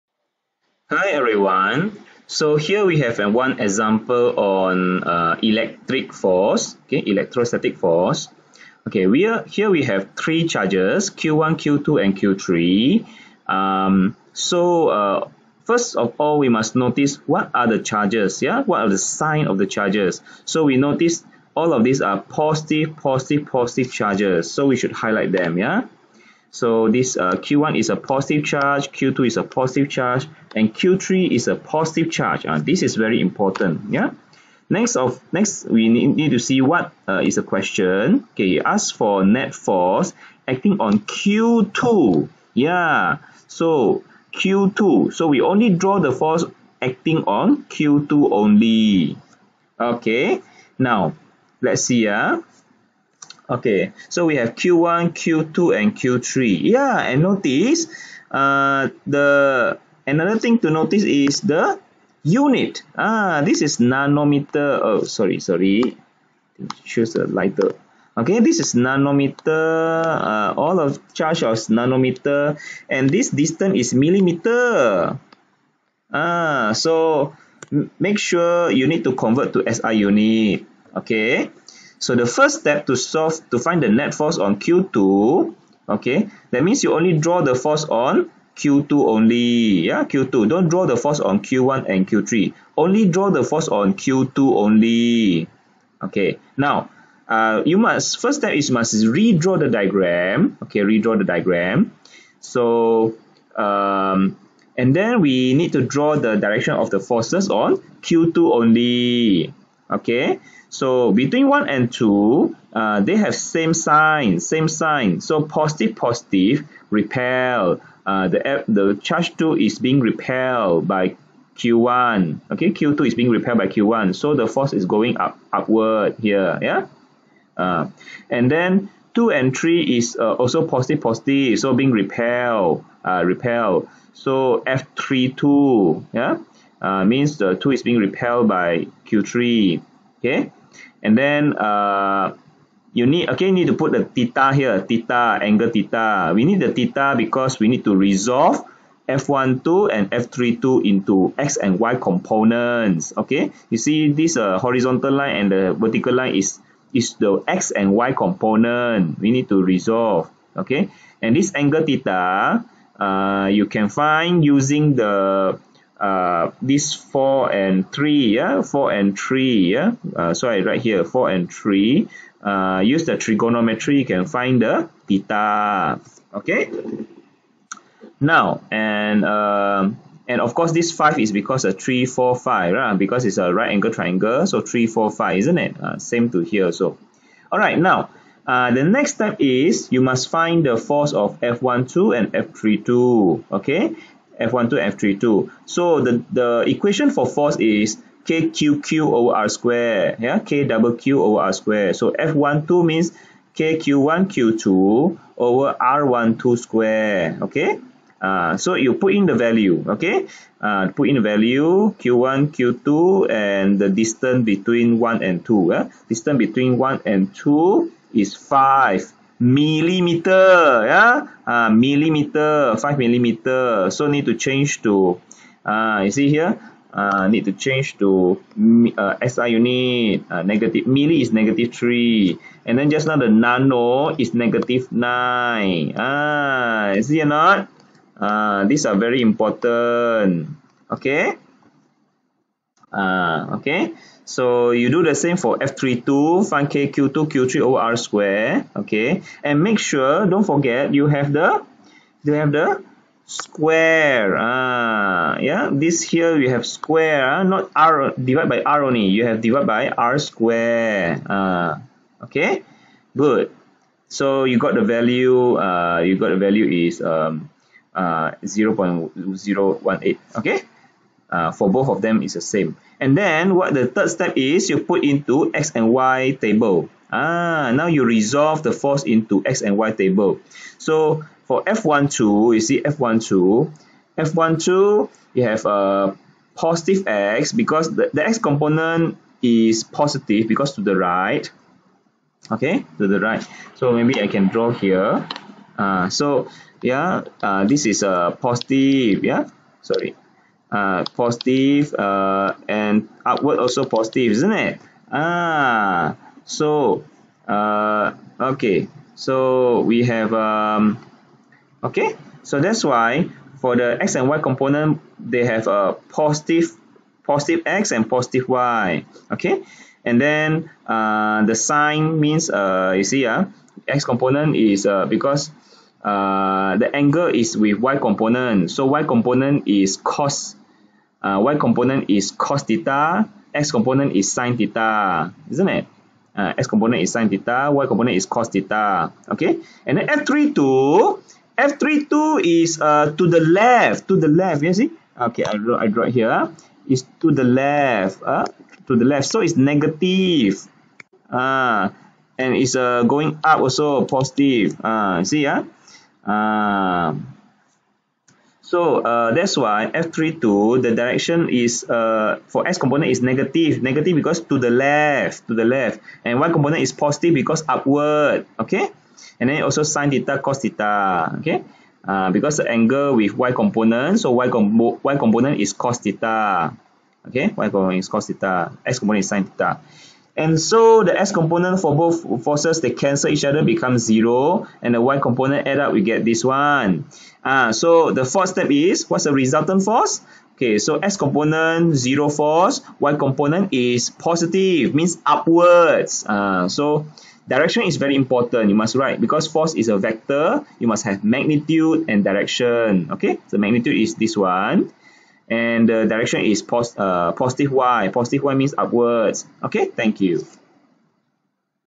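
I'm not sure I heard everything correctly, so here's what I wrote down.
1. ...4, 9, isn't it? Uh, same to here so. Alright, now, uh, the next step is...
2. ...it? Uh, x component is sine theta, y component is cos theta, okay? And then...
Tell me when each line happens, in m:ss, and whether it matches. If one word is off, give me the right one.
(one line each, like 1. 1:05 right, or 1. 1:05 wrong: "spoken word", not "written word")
1. 3:04 wrong: "5", not "9"
2. 5:35 right.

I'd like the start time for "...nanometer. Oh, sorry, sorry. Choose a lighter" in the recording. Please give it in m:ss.
1:03.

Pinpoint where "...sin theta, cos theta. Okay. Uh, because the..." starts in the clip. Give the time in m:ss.
6:09.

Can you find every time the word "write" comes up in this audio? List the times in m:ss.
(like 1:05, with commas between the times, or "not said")
2:50, 6:38.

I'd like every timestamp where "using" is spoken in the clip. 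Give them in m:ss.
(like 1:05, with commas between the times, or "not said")
2:44.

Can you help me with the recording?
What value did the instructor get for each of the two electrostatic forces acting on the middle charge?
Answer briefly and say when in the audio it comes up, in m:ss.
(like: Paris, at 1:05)
0.018, at 4:28.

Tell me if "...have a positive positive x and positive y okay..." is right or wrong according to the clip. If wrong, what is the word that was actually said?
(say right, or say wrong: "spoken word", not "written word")
right.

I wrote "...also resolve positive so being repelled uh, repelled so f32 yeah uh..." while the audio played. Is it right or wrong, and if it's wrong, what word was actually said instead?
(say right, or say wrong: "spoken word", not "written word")
wrong: "positive", not "resolve".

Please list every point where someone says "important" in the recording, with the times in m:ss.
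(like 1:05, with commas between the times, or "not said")
0:33, 3:59, 6:38.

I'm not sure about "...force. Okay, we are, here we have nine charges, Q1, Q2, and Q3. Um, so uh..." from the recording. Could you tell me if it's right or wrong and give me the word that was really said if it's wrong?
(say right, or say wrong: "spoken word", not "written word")
wrong: "three", not "nine".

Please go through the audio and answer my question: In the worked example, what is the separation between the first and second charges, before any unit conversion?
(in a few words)
5 millimeters.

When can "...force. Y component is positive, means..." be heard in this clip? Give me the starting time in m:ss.
6:32.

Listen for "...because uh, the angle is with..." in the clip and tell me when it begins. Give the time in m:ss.
5:25.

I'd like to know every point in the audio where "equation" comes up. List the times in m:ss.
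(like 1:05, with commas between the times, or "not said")
3:16.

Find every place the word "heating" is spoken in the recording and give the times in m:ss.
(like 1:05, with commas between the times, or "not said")
not said.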